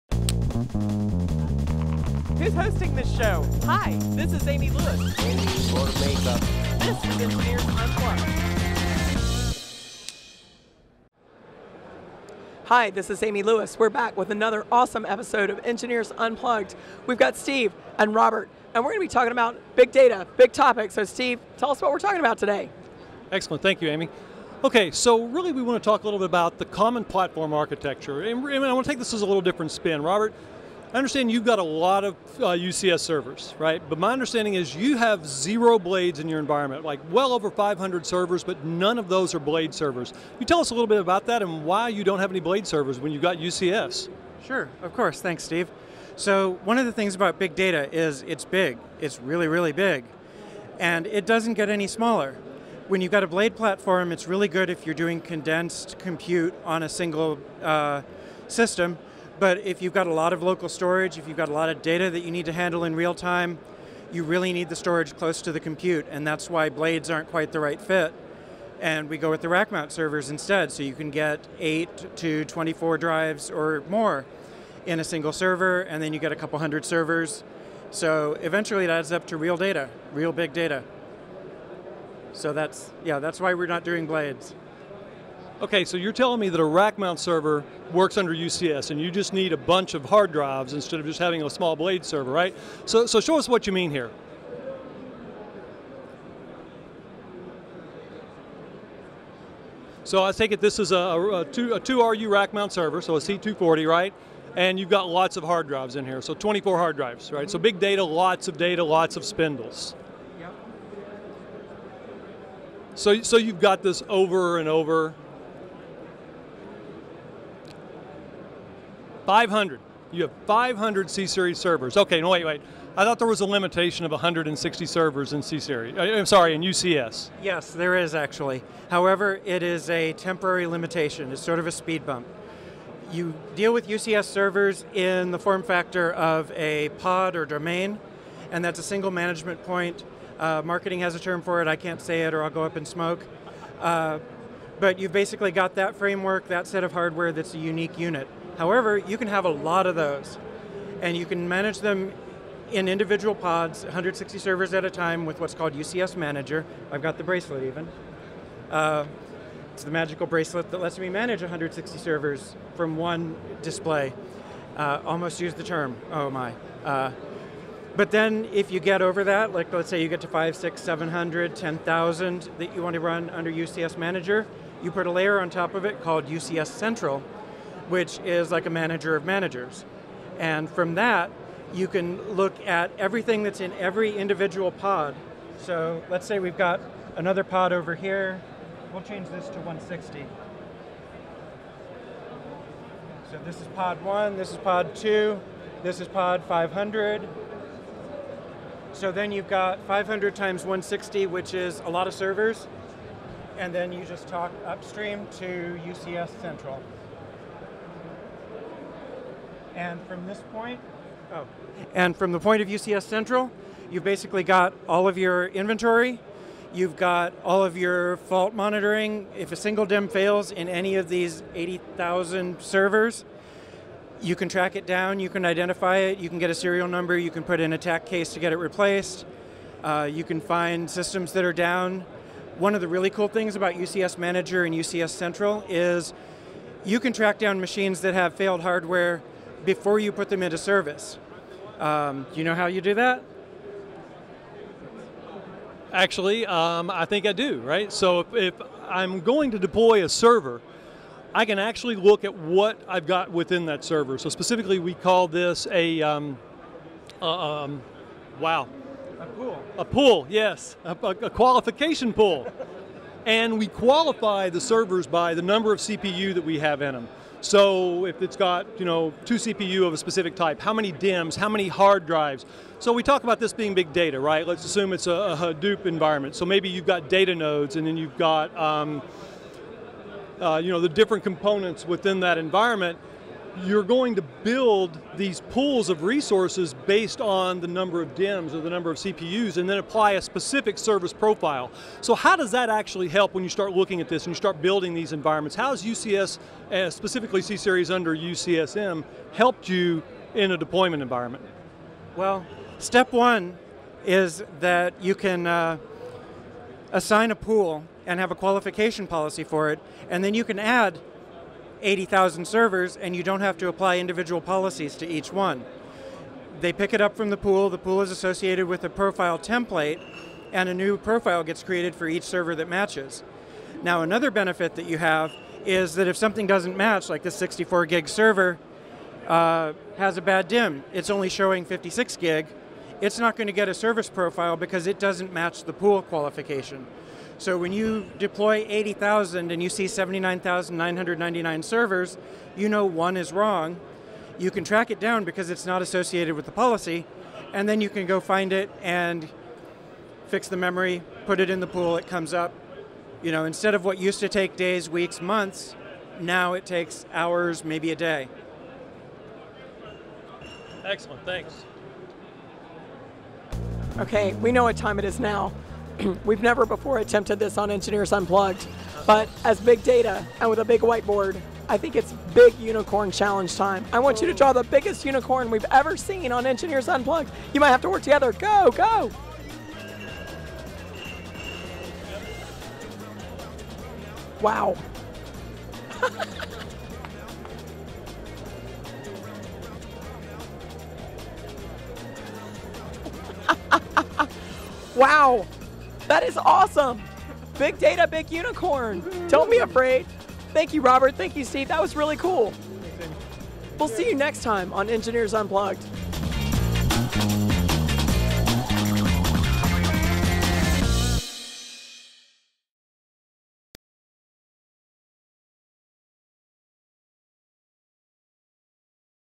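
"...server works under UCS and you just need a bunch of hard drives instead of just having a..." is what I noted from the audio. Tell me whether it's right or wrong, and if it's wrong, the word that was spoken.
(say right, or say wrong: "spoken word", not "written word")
right.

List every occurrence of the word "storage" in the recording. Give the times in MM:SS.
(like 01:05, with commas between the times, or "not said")
01:00, 01:04.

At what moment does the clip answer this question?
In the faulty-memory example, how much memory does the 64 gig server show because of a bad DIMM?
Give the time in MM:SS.
05:31.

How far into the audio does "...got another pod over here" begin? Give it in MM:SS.
03:06.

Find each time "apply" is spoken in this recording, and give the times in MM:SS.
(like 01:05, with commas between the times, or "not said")
04:49, 05:13.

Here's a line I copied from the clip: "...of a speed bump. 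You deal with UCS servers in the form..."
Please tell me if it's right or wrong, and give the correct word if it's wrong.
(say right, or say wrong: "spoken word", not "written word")
right.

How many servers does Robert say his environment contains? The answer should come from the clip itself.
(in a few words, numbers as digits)
Over 500.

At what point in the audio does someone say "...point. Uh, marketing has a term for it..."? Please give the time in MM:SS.
02:19.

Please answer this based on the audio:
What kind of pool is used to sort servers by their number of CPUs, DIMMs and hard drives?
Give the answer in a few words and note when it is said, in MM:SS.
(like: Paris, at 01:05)
Qualification pool, at 04:21.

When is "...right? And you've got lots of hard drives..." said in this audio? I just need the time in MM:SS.
01:43.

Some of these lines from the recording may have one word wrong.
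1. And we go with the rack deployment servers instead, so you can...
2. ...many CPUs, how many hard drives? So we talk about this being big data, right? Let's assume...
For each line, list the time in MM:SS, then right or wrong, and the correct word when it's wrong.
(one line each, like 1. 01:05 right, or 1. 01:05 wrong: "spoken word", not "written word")
1. 01:08 wrong: "mount", not "deployment"
2. 04:30 wrong: "DIMMs", not "CPUs".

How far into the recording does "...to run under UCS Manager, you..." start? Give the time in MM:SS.
02:52.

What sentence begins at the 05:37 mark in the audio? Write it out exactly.
So when you deploy 80,000 and you see 79,999 servers, you know one is wrong.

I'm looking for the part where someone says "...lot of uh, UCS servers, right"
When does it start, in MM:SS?
00:31.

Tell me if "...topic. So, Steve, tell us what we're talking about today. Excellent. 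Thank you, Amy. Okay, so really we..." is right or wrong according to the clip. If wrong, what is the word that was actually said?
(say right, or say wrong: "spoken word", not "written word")
right.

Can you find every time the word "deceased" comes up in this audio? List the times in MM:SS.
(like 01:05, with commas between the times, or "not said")
not said.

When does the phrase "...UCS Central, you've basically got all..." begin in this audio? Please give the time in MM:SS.
03:32.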